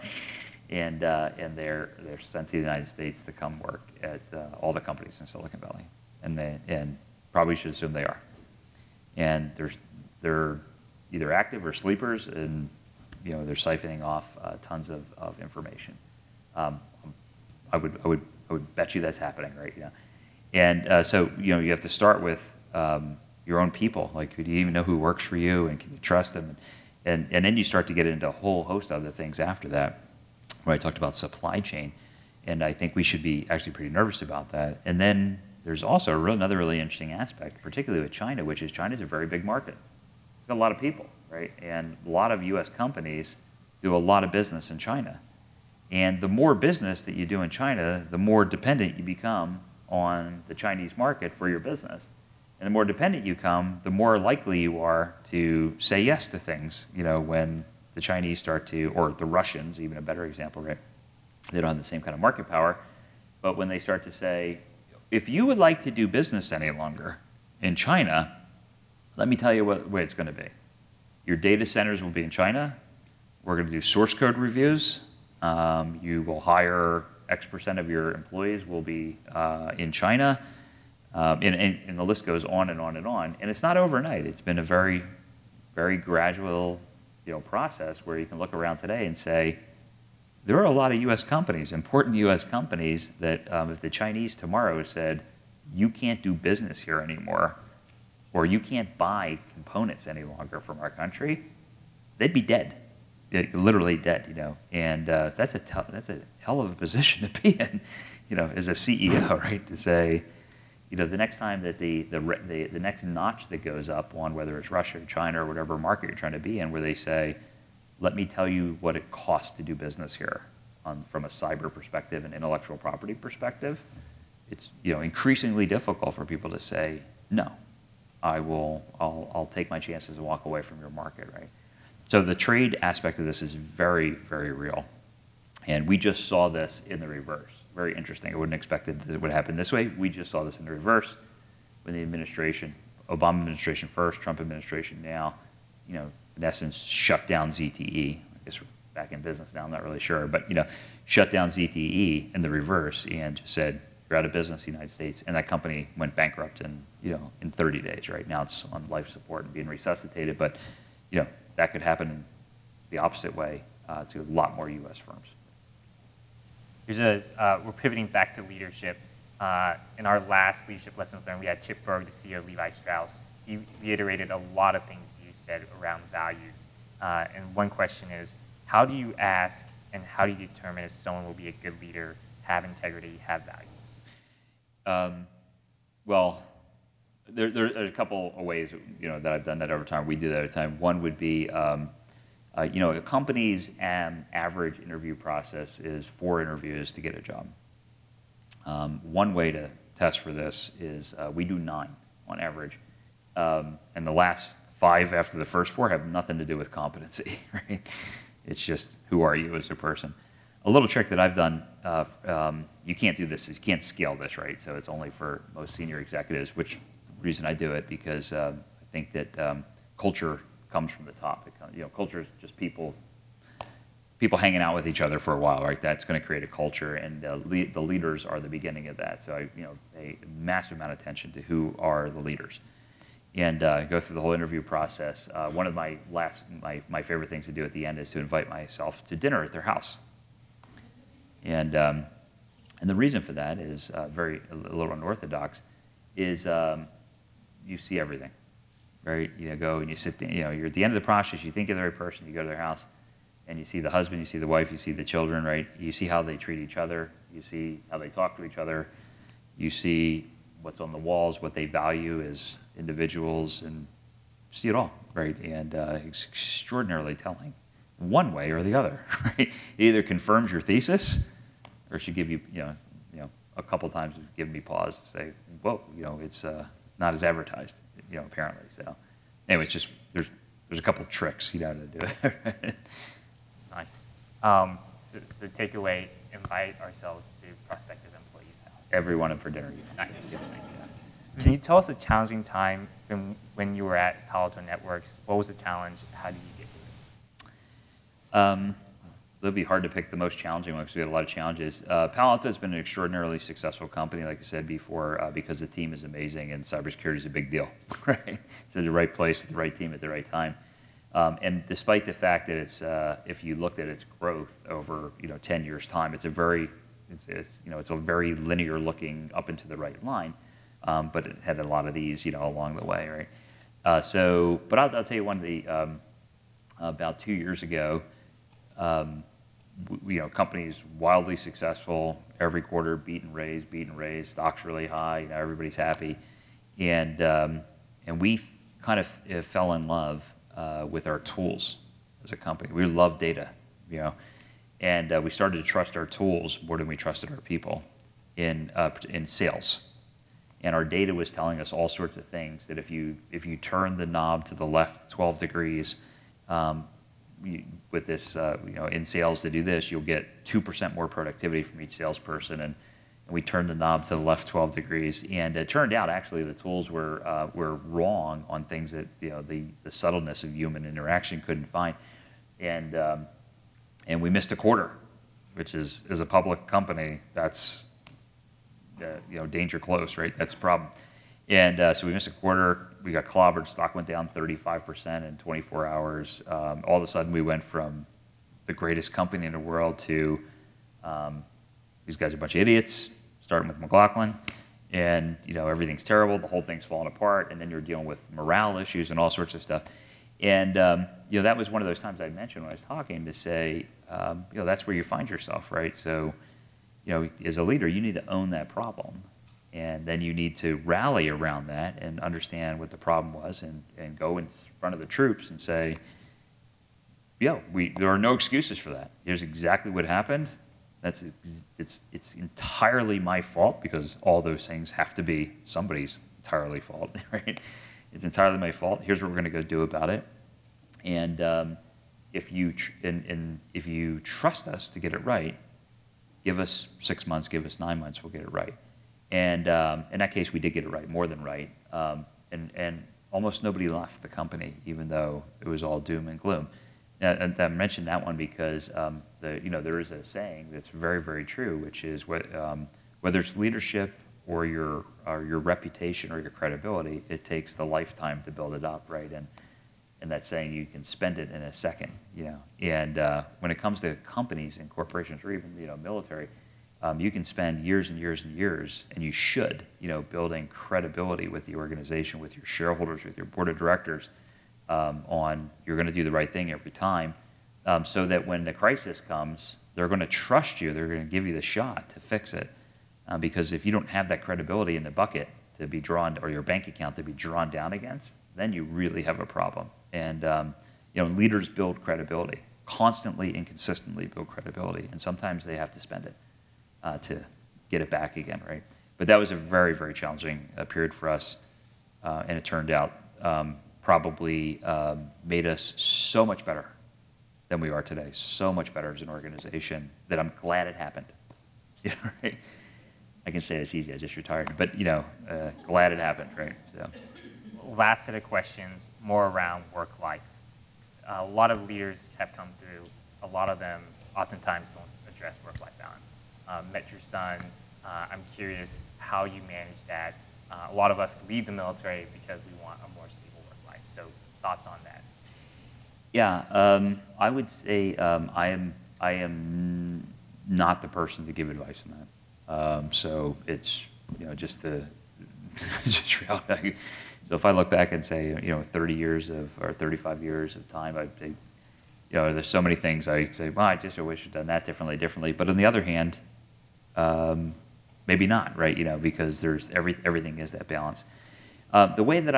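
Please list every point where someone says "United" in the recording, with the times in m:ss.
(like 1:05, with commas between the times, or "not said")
0:02, 2:34.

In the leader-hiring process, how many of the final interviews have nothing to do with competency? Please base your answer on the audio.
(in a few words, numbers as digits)
5.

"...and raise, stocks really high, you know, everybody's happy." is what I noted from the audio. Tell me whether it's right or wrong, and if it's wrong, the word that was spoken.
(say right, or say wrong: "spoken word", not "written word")
right.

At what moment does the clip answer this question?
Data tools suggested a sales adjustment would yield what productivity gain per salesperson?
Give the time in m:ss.
6:00.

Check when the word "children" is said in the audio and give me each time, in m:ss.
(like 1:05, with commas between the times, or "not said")
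4:15.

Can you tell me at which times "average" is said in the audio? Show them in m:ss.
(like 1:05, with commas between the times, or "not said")
3:14, 3:22.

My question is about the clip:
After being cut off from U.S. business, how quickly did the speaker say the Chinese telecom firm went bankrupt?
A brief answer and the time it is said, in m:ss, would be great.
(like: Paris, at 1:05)
30 days, at 2:37.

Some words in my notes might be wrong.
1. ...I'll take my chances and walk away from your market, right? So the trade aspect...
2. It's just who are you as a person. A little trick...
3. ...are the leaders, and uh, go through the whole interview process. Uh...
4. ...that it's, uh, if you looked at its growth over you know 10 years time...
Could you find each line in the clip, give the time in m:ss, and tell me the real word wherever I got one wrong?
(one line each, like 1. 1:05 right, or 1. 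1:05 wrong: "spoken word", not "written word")
1. 2:09 right
2. 3:28 right
3. 3:51 right
4. 5:12 right.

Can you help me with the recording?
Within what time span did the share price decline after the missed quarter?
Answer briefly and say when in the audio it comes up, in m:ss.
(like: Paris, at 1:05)
24 hours, at 6:25.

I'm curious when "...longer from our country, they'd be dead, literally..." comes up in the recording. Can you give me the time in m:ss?
1:40.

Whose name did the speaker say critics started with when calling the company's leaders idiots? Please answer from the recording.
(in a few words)
McLaughlin.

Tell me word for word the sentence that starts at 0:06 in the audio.
And, they, and probably should assume they are.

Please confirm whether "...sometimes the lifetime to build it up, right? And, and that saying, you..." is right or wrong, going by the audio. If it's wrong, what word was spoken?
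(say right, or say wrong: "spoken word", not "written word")
wrong: "takes", not "sometimes".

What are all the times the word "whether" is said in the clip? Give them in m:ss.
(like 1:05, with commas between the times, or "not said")
1:54, 7:33.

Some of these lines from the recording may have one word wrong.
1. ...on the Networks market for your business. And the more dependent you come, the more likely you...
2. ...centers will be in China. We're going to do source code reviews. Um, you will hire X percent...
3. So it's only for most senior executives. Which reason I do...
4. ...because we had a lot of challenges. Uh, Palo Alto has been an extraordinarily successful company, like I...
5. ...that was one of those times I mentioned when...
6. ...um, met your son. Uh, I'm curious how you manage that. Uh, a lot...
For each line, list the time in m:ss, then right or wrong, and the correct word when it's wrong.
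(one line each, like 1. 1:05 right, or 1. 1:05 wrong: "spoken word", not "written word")
1. 0:49 wrong: "Chinese", not "Networks"
2. 1:11 right
3. 3:34 right
4. 5:00 right
5. 6:41 right
6. 8:46 right.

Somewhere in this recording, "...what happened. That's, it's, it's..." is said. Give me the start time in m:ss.
6:59.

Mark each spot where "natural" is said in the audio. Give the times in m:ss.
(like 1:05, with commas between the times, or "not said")
not said.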